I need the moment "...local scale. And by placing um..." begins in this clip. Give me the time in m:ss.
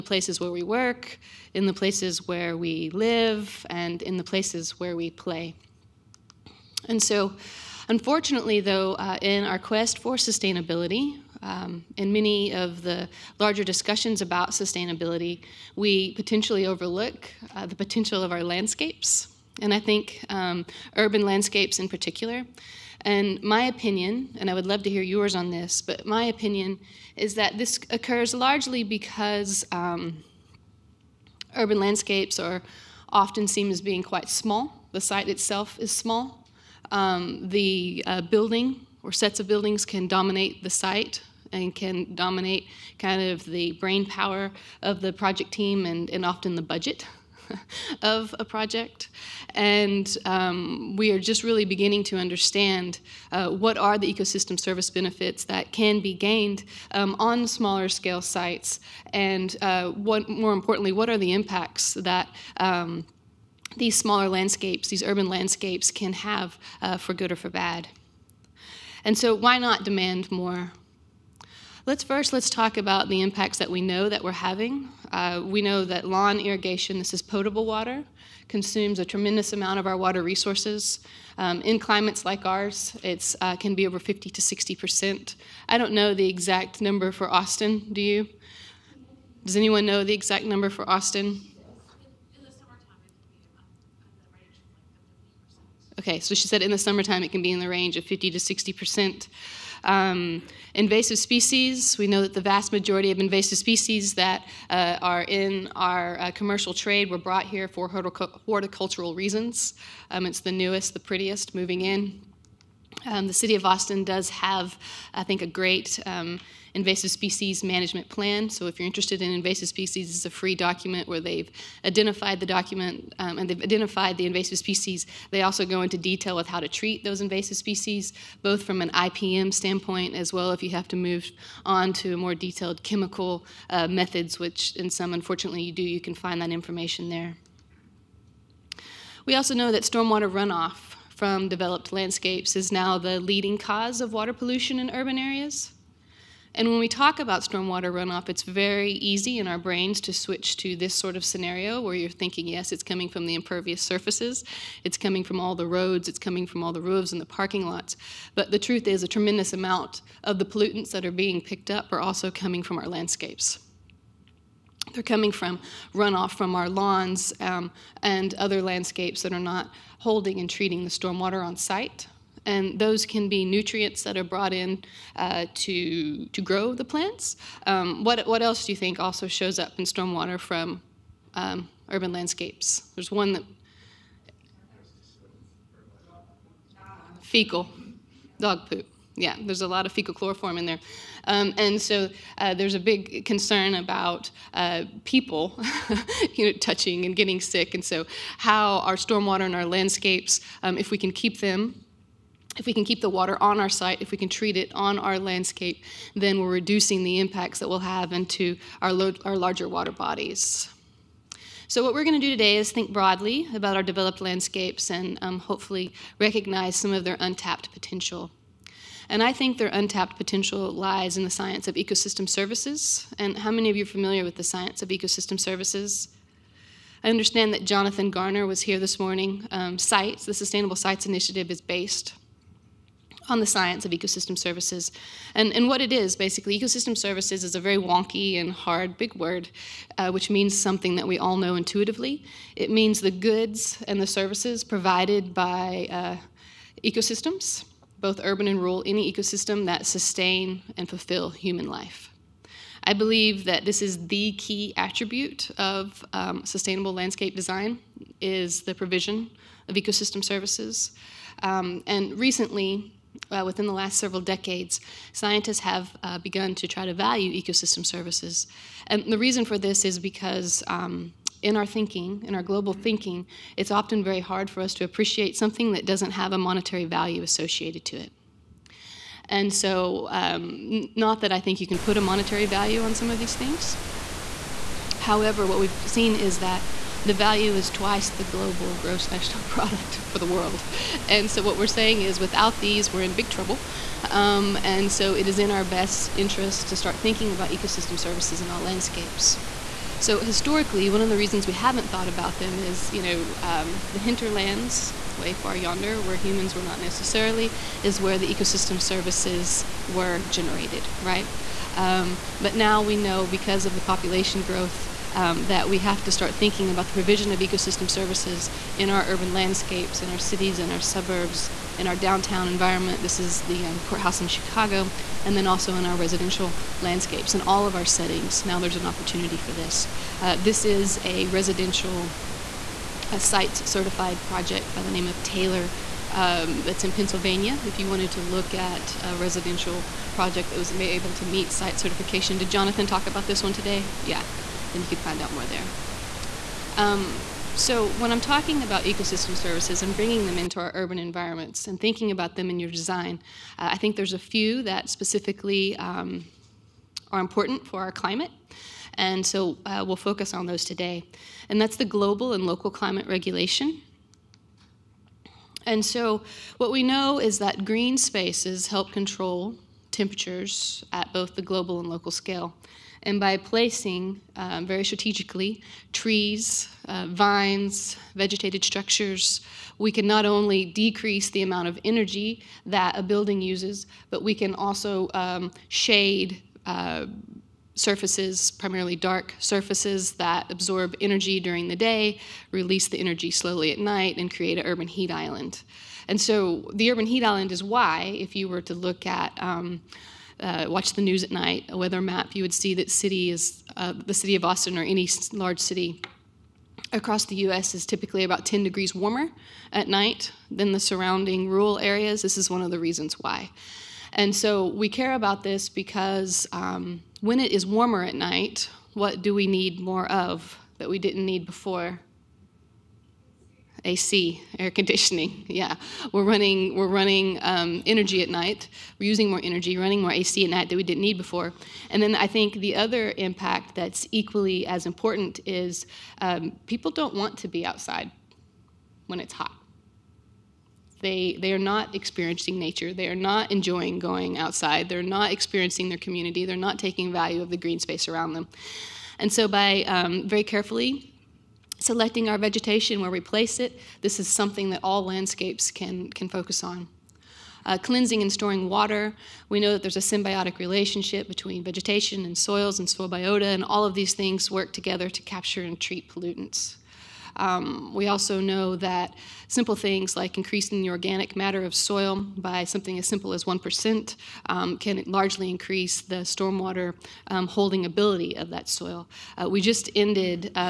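6:11.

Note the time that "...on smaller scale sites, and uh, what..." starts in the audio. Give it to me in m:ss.
0:57.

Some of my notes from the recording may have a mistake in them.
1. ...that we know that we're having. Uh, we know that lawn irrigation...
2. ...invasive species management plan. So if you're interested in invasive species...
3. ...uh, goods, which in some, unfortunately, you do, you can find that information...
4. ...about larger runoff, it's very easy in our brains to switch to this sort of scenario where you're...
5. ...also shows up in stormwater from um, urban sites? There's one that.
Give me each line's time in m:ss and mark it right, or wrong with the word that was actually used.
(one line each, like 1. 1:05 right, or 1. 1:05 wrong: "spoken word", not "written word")
1. 1:13 right
2. 1:56 right
3. 2:13 wrong: "methods", not "goods"
4. 2:27 wrong: "stormwater", not "larger"
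5. 2:58 wrong: "landscapes", not "sites".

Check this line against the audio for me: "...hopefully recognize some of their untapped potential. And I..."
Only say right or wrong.
right.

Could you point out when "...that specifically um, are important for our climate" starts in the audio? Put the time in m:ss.
5:54.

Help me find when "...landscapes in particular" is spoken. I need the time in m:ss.
0:21.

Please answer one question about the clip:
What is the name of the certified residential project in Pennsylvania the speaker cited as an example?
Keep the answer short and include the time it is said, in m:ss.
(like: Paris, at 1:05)
Taylor, at 5:35.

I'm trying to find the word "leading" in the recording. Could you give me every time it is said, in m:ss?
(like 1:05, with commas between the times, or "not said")
2:23.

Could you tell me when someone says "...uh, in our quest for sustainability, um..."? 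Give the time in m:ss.
0:08.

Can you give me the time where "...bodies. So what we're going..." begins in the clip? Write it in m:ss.
3:29.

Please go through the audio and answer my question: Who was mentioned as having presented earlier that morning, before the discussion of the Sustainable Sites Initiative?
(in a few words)
Jonathan Garner.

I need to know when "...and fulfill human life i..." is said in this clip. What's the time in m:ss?
4:10.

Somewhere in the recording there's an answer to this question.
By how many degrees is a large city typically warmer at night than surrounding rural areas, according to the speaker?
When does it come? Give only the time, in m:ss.
6:48.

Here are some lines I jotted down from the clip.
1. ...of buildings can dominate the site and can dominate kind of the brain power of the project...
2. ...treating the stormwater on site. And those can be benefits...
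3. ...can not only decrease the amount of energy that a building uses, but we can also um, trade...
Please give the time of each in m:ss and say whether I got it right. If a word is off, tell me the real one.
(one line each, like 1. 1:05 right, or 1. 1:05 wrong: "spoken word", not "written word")
1. 0:39 right
2. 2:50 wrong: "nutrients", not "benefits"
3. 6:19 wrong: "shade", not "trade".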